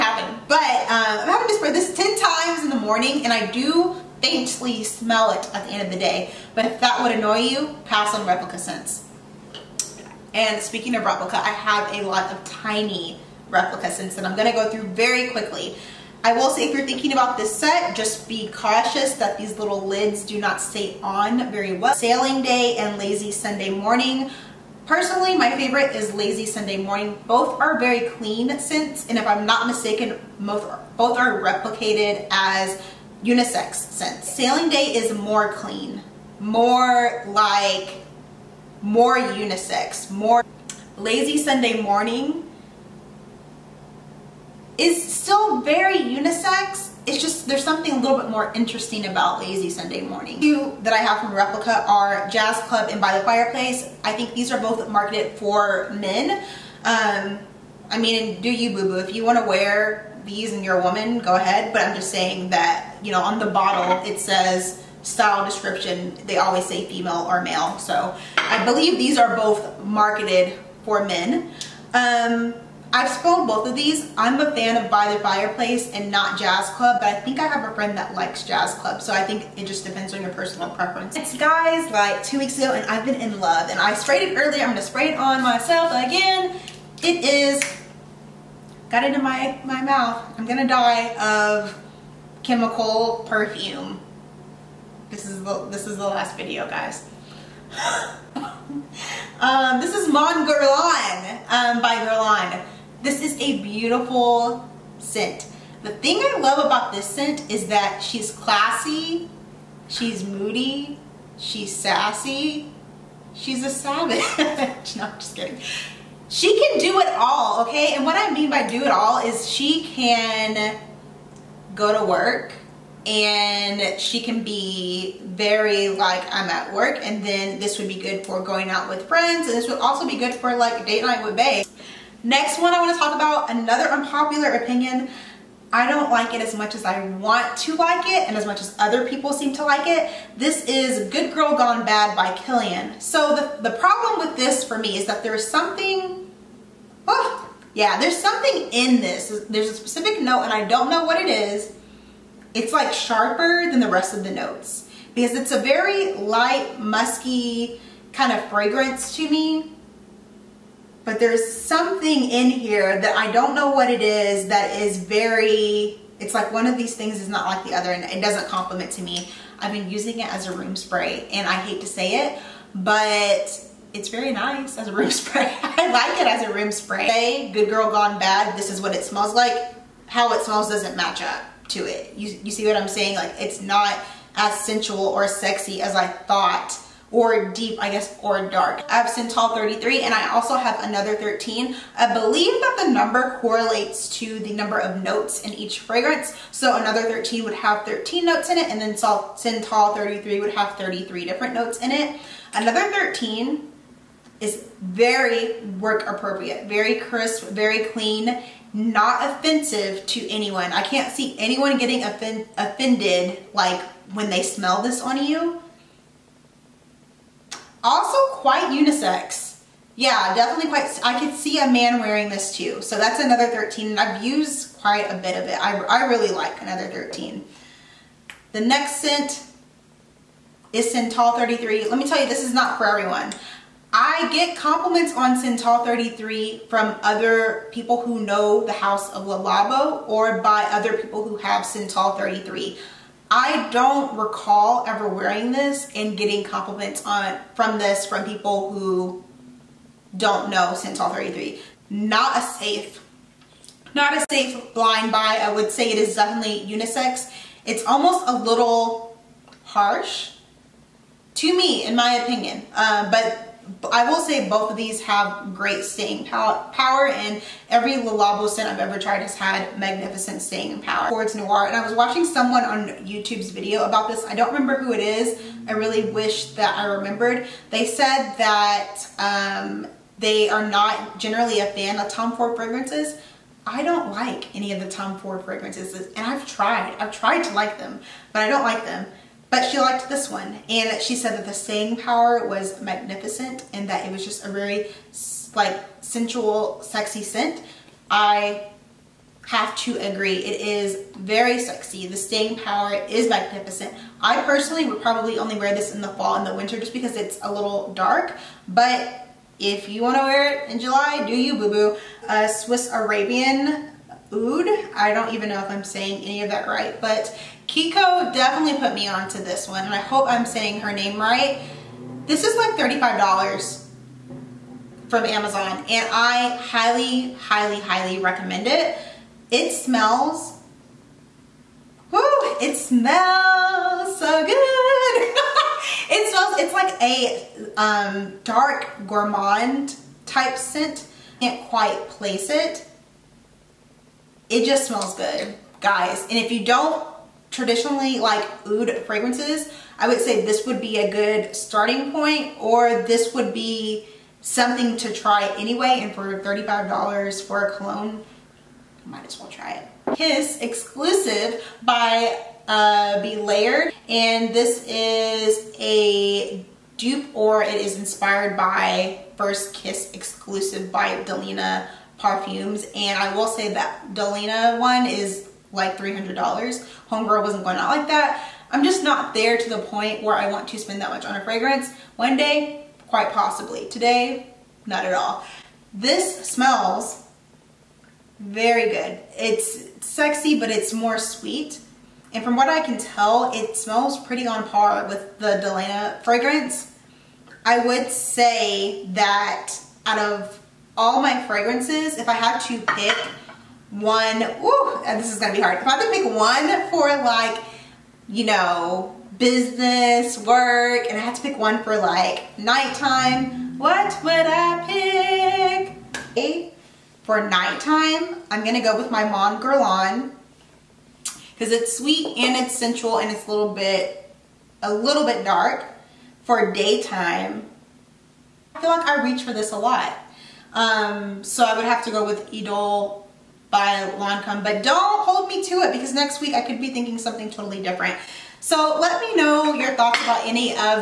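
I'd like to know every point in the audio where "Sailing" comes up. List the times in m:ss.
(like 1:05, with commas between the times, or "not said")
0:21, 0:34.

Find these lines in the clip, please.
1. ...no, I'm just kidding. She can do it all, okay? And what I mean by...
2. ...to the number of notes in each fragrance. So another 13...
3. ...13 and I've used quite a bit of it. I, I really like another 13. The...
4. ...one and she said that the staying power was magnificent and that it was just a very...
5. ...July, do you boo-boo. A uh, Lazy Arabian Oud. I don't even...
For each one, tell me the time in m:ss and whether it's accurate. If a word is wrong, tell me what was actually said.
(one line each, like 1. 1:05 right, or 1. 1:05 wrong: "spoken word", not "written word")
1. 1:54 right
2. 3:14 right
3. 3:43 right
4. 4:50 right
5. 5:10 wrong: "Swiss", not "Lazy".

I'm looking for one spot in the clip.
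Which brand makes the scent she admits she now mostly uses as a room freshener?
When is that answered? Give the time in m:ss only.
2:21.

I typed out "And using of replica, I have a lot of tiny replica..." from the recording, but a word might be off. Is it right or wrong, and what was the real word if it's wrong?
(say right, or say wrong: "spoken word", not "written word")
wrong: "speaking", not "using".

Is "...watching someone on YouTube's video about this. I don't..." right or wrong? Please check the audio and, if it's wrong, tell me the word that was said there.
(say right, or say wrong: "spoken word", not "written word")
right.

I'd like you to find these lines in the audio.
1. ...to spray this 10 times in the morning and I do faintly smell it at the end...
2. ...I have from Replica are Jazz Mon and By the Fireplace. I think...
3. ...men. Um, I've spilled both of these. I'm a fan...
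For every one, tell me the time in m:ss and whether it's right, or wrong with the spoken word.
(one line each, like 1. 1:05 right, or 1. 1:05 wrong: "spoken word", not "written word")
1. 0:01 right
2. 0:50 wrong: "Club", not "Mon"
3. 1:11 right.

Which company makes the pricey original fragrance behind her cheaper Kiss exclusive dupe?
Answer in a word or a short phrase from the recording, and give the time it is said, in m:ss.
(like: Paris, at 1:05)
Delina Perfumes, at 6:11.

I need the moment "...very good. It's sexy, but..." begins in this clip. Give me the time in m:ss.
6:28.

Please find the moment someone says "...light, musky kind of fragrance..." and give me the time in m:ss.
2:36.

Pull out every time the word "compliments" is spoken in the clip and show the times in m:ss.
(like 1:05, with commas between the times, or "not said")
2:48, 3:54, 4:06.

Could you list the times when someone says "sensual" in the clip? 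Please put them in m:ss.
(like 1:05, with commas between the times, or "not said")
3:04, 4:56, 7:02.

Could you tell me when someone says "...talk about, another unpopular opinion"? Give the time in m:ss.
2:12.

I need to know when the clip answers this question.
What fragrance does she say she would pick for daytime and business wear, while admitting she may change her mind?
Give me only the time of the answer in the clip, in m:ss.
7:12.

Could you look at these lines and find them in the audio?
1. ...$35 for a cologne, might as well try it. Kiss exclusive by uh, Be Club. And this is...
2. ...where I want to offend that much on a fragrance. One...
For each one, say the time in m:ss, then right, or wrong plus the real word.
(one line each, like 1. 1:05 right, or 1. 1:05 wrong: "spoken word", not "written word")
1. 5:56 wrong: "Layered", not "Club"
2. 6:20 wrong: "spend", not "offend".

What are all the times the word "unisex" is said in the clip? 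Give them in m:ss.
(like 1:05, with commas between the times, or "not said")
0:33, 0:39, 0:45, 3:38, 4:16.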